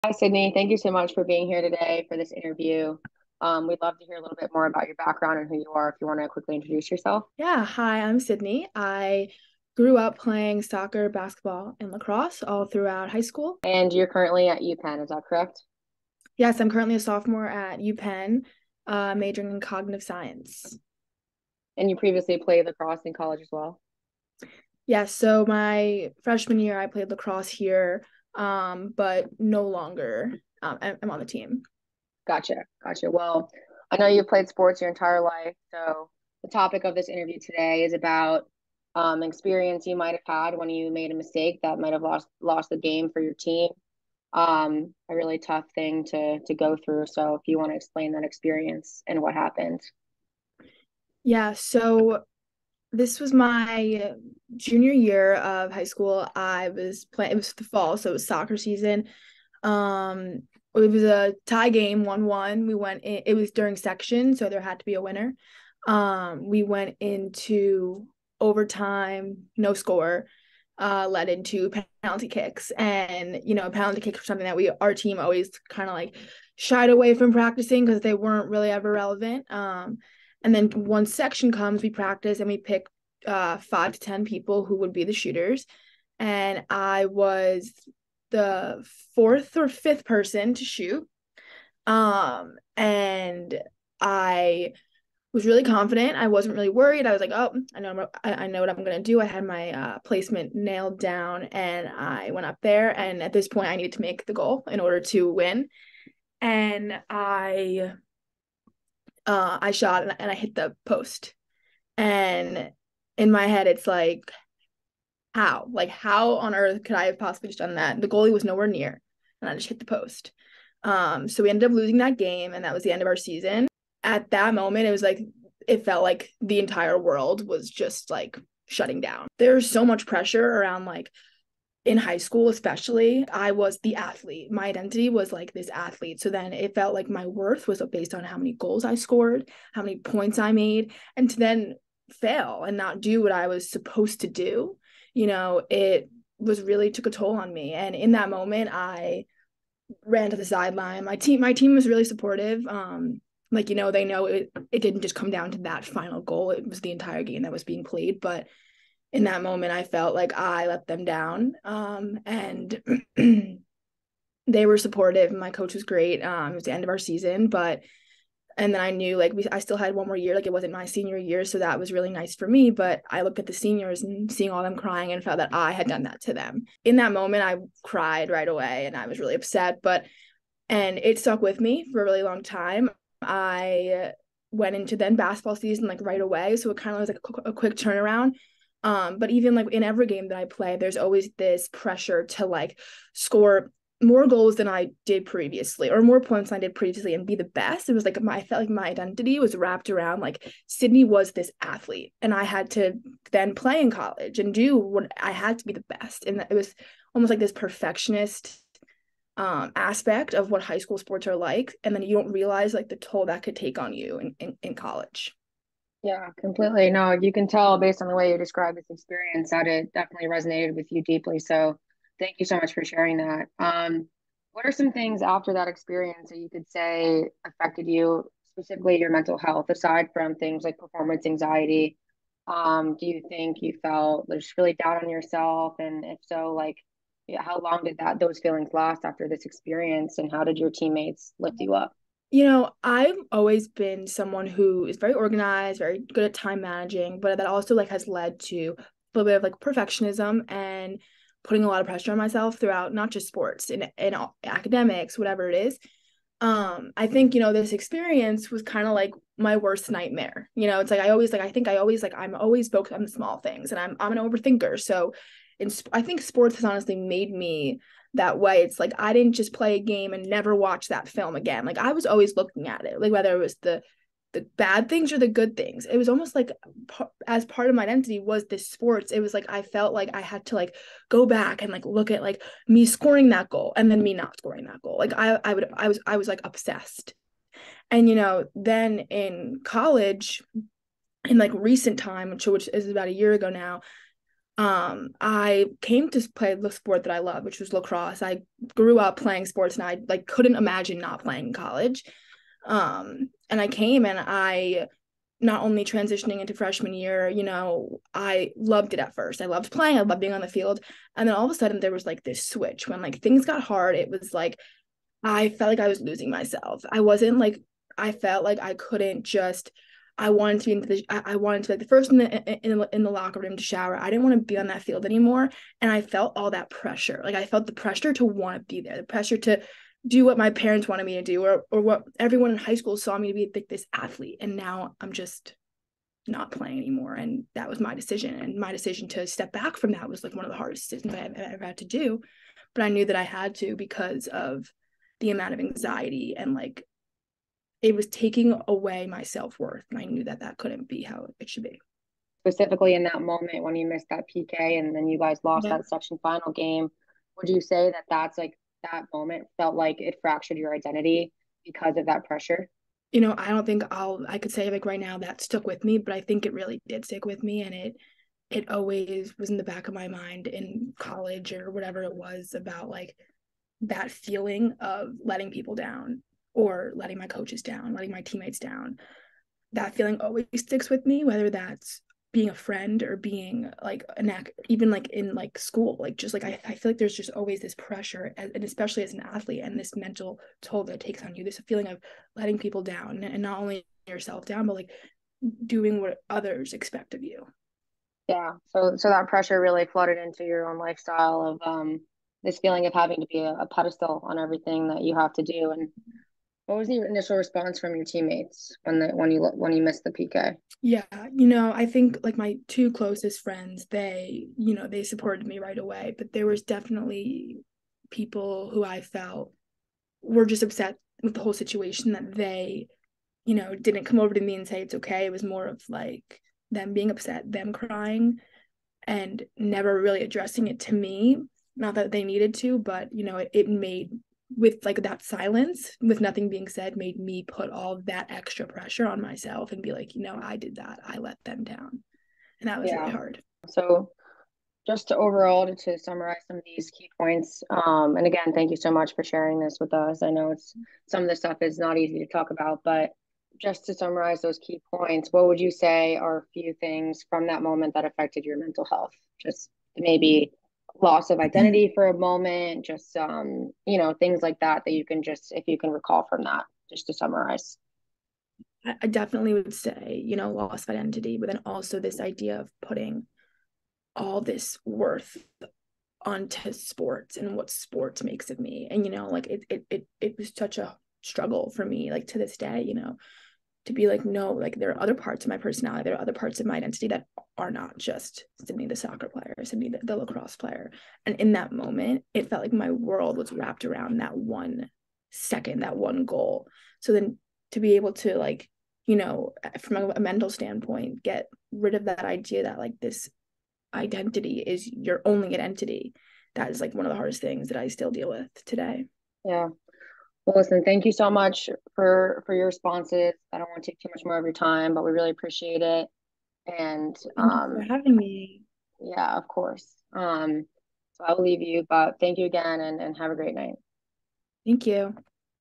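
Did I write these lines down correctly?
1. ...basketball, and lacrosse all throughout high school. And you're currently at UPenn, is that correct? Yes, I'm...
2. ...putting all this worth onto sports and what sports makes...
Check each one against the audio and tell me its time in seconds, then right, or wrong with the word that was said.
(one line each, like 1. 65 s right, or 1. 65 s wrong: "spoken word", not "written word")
1. 11 s right
2. 472 s right.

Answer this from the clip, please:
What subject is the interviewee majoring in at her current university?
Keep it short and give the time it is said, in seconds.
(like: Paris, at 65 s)
Cognitive science, at 19 s.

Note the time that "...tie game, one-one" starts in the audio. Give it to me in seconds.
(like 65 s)
61 s.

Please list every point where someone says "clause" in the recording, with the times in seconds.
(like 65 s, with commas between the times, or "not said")
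not said.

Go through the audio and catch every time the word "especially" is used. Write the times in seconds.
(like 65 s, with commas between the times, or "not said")
132 s, 388 s.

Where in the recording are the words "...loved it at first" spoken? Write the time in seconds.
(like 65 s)
308 s.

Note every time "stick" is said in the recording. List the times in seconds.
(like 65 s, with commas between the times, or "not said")
367 s, 380 s.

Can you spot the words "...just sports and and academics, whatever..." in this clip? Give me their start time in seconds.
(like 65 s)
253 s.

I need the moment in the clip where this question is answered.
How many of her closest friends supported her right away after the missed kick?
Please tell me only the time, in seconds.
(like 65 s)
412 s.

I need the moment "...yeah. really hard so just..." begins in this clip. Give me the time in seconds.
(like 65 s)
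442 s.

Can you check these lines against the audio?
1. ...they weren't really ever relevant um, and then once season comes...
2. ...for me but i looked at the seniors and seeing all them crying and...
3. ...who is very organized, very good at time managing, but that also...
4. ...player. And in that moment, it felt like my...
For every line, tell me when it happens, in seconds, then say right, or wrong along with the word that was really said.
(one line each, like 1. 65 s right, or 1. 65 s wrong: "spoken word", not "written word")
1. 78 s wrong: "section", not "season"
2. 172 s right
3. 244 s right
4. 490 s right.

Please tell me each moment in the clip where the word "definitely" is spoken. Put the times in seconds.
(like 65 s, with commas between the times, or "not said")
219 s, 416 s, 469 s.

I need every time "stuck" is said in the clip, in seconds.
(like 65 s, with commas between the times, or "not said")
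181 s, 365 s.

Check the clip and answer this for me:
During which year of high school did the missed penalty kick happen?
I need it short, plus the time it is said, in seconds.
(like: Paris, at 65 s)
Junior year, at 54 s.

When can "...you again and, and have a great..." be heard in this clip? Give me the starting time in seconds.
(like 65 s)
522 s.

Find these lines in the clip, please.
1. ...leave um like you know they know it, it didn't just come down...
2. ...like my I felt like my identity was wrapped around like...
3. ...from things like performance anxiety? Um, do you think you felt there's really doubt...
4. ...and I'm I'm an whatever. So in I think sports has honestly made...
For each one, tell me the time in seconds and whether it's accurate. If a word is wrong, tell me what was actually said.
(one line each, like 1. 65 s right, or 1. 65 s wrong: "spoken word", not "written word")
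1. 152 s wrong: "supportive", not "leave"
2. 198 s right
3. 230 s right
4. 263 s wrong: "overthinker", not "whatever".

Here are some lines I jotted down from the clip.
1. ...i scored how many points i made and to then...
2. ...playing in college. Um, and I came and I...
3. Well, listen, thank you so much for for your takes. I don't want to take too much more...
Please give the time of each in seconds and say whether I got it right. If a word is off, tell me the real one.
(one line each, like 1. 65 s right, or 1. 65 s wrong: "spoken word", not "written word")
1. 138 s right
2. 301 s right
3. 510 s wrong: "responses", not "takes".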